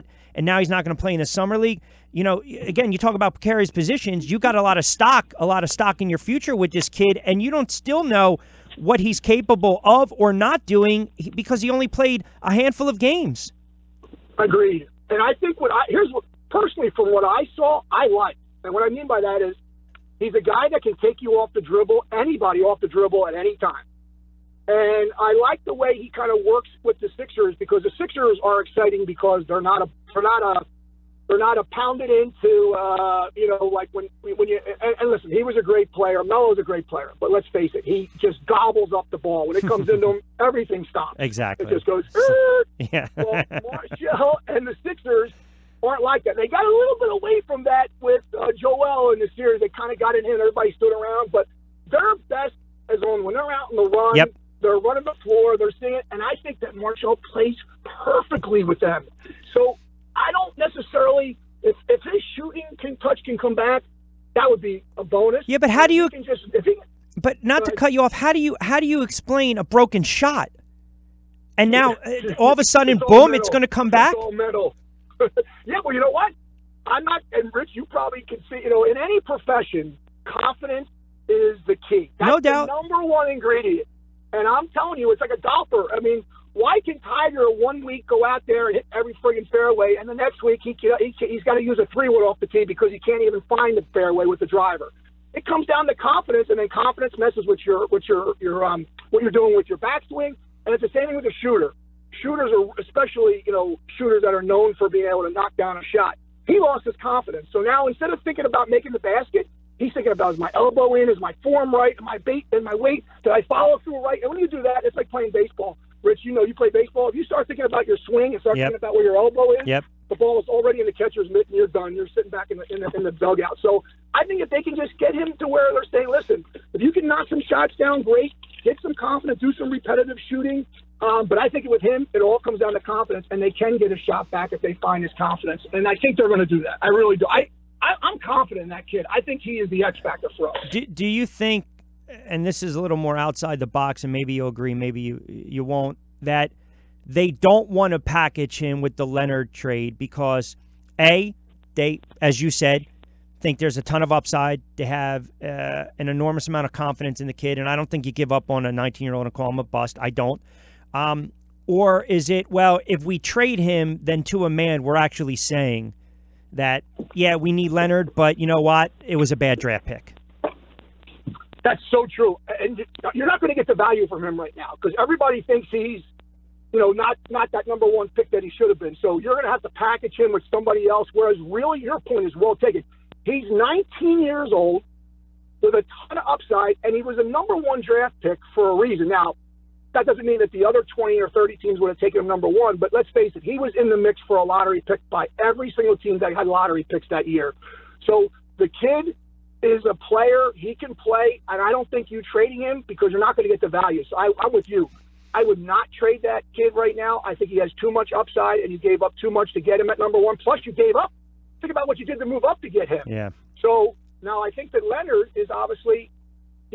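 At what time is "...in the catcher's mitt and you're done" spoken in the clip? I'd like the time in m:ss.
2:00.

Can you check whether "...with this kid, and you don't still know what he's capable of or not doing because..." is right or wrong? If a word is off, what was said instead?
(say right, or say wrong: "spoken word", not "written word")
right.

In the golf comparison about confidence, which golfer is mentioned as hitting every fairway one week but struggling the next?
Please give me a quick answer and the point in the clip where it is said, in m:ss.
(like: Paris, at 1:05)
Tiger, at 1:26.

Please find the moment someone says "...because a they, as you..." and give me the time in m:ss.
2:29.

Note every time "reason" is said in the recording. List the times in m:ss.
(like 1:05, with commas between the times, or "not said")
3:08.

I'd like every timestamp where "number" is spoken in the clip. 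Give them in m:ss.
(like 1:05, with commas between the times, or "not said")
1:22, 2:57, 3:07, 3:12, 3:29.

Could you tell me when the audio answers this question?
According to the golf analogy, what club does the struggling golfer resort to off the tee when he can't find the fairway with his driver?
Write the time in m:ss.
1:31.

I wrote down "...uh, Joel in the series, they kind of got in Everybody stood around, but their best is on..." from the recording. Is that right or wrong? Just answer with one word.
right.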